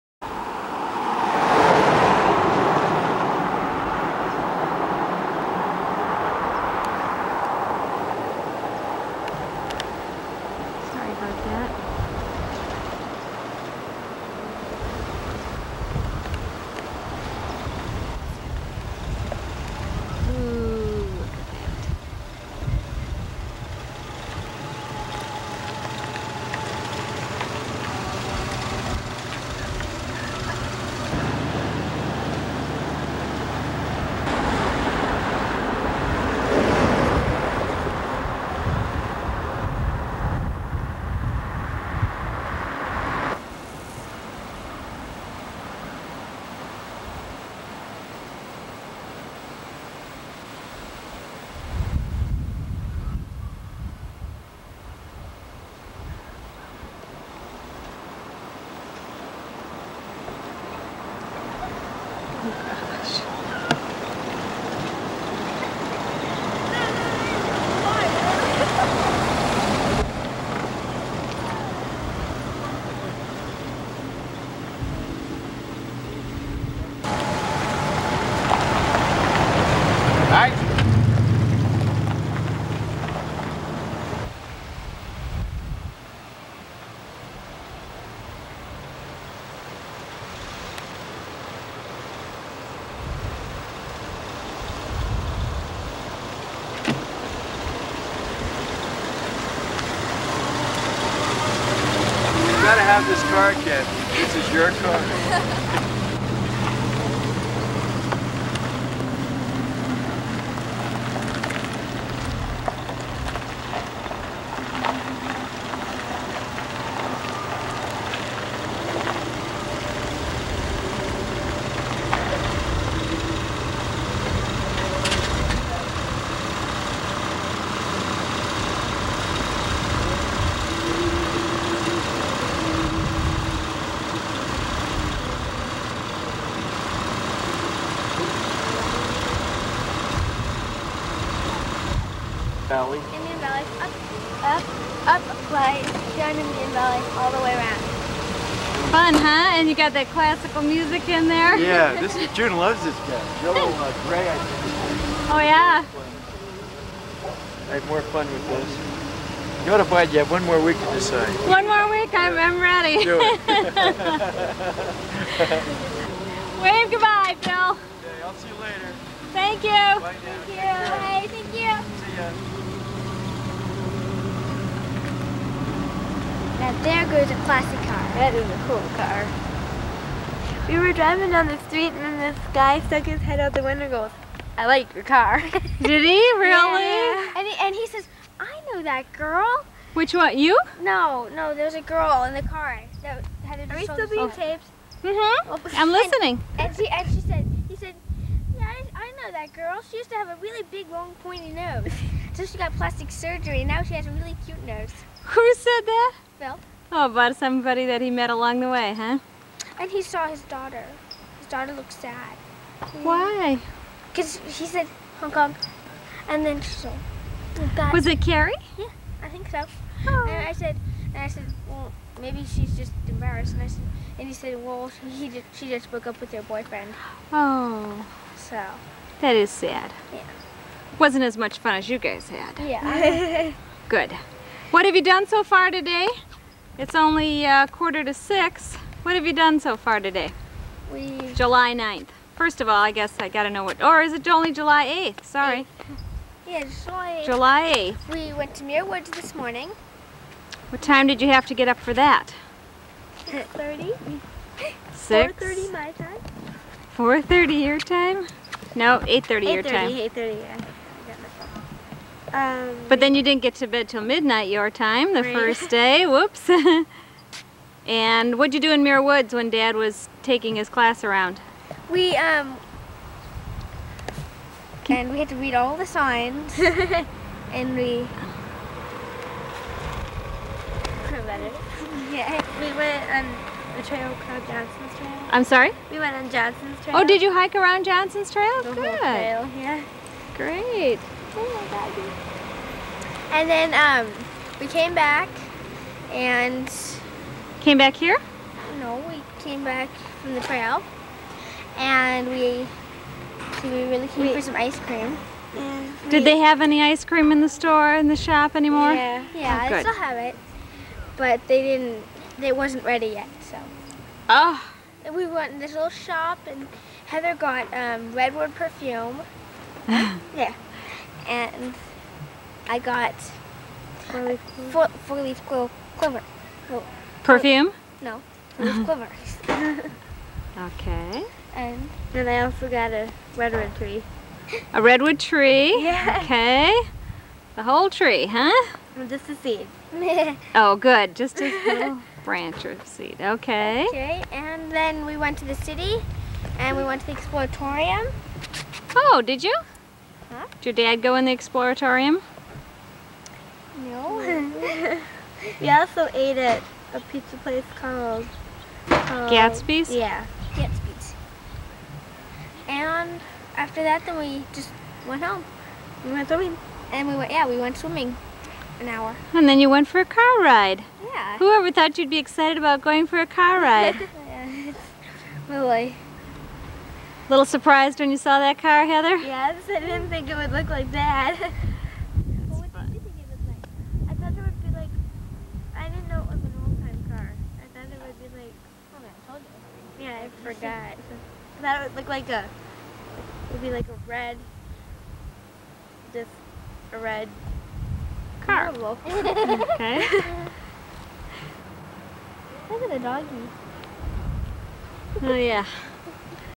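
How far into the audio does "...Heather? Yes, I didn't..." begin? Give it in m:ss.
6:18.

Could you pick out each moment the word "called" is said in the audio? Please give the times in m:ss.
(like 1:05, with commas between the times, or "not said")
4:44, 5:57.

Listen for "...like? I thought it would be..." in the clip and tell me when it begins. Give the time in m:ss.
6:23.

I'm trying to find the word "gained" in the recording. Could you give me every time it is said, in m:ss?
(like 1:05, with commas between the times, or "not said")
not said.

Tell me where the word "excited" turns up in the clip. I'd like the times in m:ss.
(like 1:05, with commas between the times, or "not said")
6:12.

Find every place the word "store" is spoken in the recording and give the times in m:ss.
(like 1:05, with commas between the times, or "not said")
5:07.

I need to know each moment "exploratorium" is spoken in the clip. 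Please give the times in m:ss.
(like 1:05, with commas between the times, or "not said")
5:47, 5:51.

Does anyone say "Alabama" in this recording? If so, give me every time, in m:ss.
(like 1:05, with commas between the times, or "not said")
not said.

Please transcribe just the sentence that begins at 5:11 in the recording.
But they didn't, they wasn't ready yet, so.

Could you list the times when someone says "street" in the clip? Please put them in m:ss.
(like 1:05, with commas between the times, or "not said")
3:01.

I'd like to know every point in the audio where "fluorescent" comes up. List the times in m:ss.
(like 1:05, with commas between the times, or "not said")
not said.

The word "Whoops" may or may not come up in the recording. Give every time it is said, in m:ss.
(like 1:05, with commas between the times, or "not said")
4:26.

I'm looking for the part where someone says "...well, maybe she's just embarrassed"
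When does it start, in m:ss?
3:41.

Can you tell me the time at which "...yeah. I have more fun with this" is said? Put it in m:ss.
2:35.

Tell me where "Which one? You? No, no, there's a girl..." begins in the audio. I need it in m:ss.
3:09.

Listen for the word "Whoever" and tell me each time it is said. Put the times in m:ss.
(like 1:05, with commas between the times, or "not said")
6:11.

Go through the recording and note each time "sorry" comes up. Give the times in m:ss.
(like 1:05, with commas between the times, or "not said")
4:05, 4:45.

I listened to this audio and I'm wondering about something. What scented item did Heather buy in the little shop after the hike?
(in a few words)
Redwood perfume.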